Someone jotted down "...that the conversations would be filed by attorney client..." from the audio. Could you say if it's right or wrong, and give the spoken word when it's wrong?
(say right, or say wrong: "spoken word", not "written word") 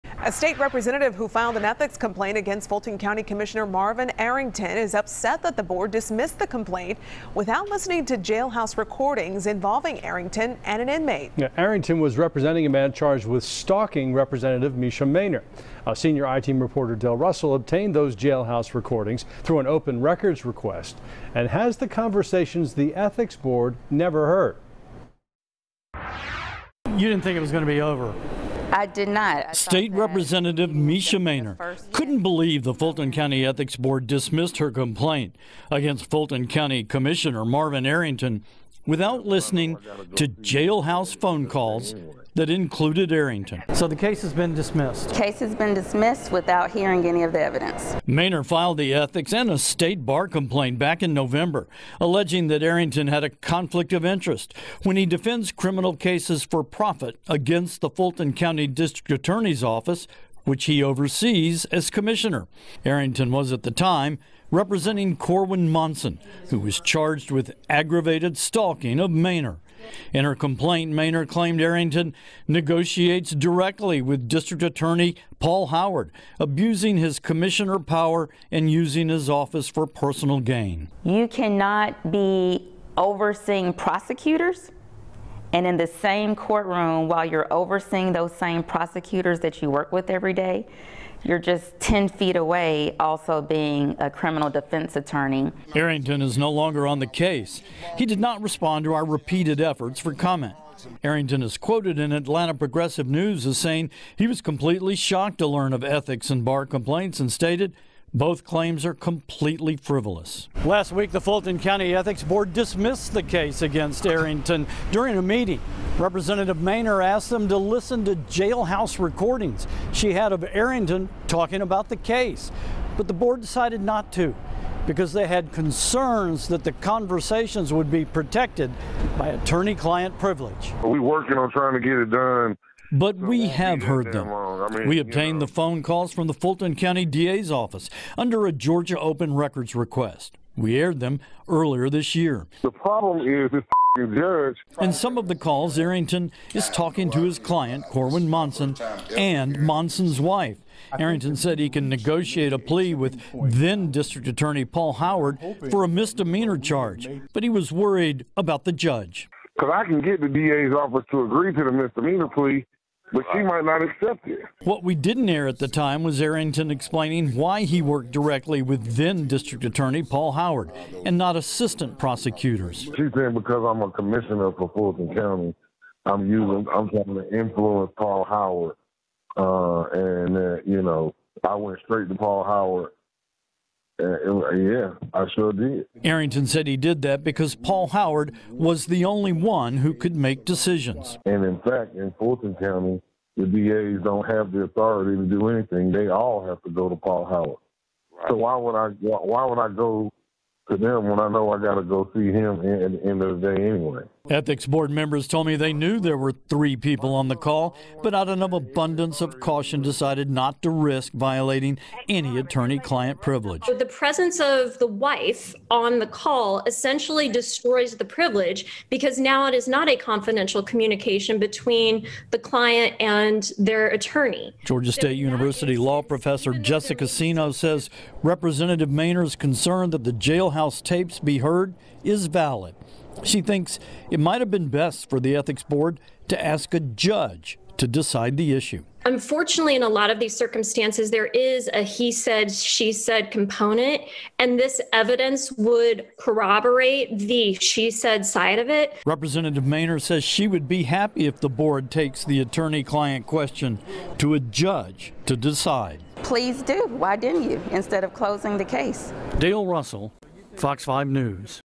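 wrong: "protected", not "filed".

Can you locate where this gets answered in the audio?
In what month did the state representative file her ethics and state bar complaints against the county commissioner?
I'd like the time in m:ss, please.
0:51.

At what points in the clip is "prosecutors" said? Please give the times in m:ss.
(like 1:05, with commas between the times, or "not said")
1:23, 1:28, 2:51.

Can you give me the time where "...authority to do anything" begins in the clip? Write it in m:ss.
3:14.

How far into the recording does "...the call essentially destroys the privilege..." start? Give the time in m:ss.
3:35.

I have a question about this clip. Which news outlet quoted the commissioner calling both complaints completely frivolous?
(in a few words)
Atlanta Progressive News.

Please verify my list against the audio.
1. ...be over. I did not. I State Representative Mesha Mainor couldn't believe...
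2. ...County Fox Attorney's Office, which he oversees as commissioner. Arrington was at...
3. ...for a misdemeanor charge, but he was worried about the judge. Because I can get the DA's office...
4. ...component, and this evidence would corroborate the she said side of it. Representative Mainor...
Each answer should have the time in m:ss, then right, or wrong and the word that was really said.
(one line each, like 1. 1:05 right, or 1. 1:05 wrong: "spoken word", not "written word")
1. 0:27 right
2. 0:58 wrong: "District", not "Fox"
3. 2:35 right
4. 4:03 right.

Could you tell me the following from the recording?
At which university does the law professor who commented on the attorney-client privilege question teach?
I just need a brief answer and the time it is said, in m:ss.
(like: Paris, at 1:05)
Georgia State University, at 3:44.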